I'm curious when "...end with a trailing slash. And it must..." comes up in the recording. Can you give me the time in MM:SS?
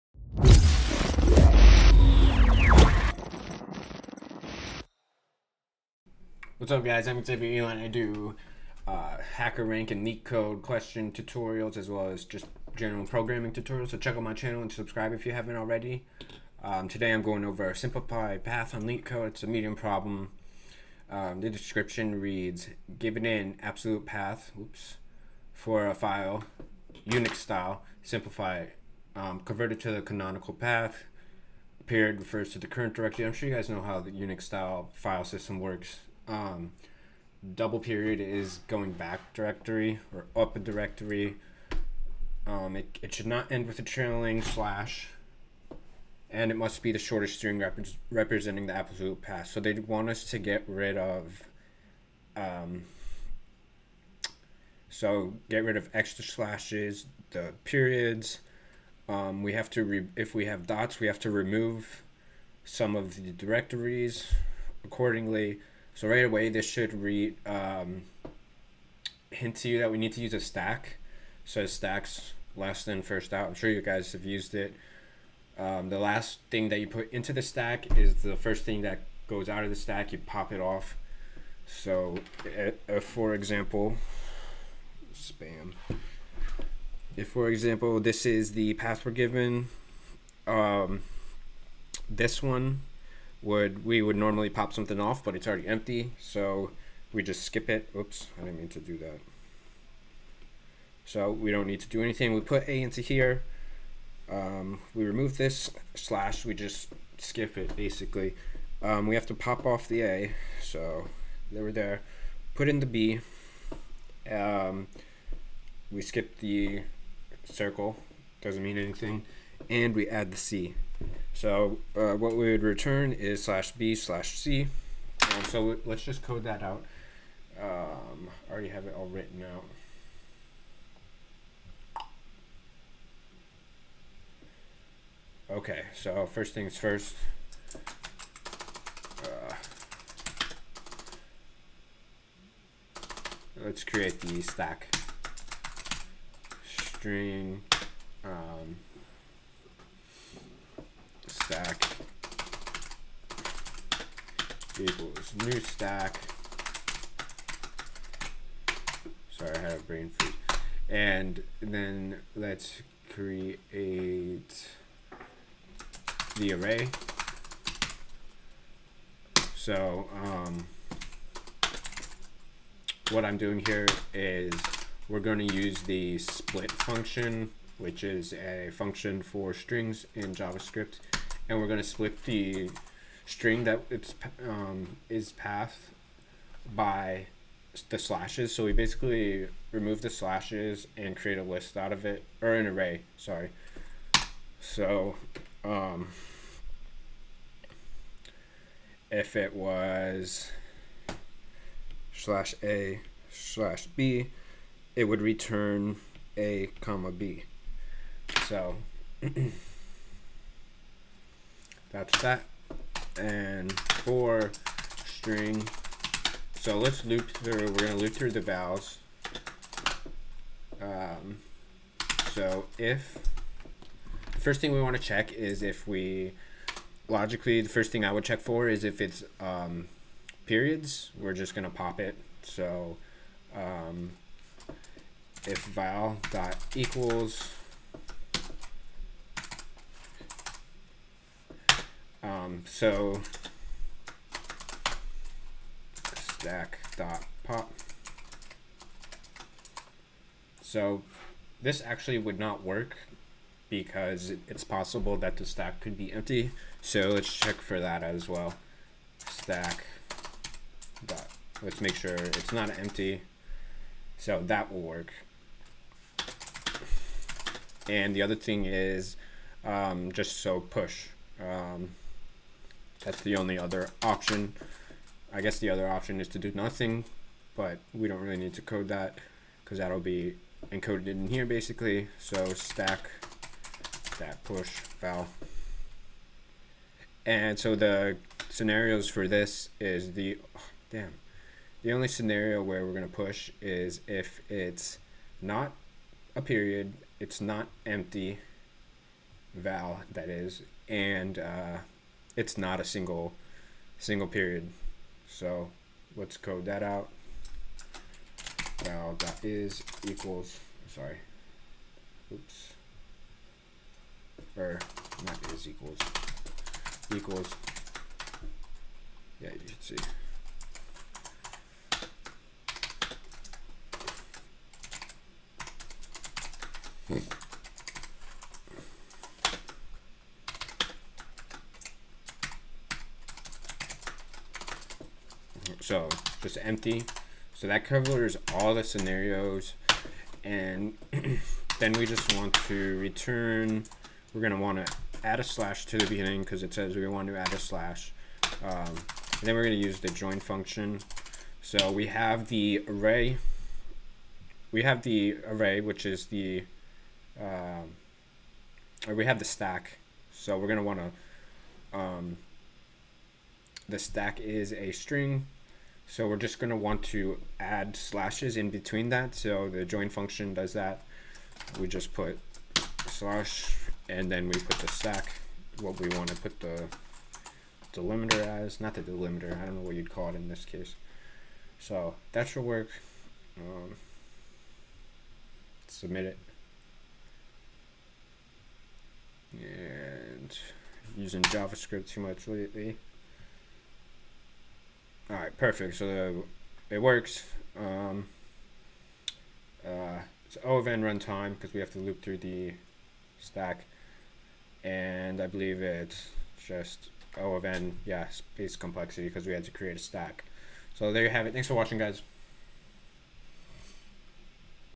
00:43.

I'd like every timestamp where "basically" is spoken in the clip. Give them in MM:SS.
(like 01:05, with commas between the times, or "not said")
01:47, 03:08, 04:41.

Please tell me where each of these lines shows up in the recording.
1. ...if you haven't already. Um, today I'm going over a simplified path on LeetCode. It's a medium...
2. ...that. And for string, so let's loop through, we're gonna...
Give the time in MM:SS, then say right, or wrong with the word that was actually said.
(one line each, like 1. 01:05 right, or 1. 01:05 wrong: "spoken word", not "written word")
1. 00:15 right
2. 03:32 right.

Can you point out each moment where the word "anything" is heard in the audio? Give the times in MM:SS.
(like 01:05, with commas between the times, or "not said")
01:42, 01:58.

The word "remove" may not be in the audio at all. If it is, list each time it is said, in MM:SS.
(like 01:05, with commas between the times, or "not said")
01:01, 01:45, 03:09.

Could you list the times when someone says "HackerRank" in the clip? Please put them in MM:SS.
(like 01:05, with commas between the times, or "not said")
00:09.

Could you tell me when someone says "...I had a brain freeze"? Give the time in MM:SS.
02:39.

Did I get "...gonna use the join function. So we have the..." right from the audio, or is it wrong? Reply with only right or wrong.
right.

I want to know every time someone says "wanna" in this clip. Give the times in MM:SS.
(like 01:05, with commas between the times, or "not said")
03:44, 05:44, 06:00.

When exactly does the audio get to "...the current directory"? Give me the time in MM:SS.
00:32.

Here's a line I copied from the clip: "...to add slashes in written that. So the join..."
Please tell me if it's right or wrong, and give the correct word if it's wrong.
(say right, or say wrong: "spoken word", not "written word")
wrong: "between", not "written".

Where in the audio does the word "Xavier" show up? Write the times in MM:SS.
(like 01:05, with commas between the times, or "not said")
00:07.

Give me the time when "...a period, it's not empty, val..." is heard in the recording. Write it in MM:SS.
04:56.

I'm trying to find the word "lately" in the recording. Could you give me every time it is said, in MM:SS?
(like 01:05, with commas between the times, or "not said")
06:32.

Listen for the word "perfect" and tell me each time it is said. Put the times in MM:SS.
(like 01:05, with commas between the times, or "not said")
06:35.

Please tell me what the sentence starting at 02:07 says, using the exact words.
Um, I already have it all written out.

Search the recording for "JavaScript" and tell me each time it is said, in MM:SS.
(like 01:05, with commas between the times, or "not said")
03:00, 06:31.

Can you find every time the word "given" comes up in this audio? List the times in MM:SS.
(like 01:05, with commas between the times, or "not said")
00:22, 01:29.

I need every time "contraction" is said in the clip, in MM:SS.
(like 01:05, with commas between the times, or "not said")
not said.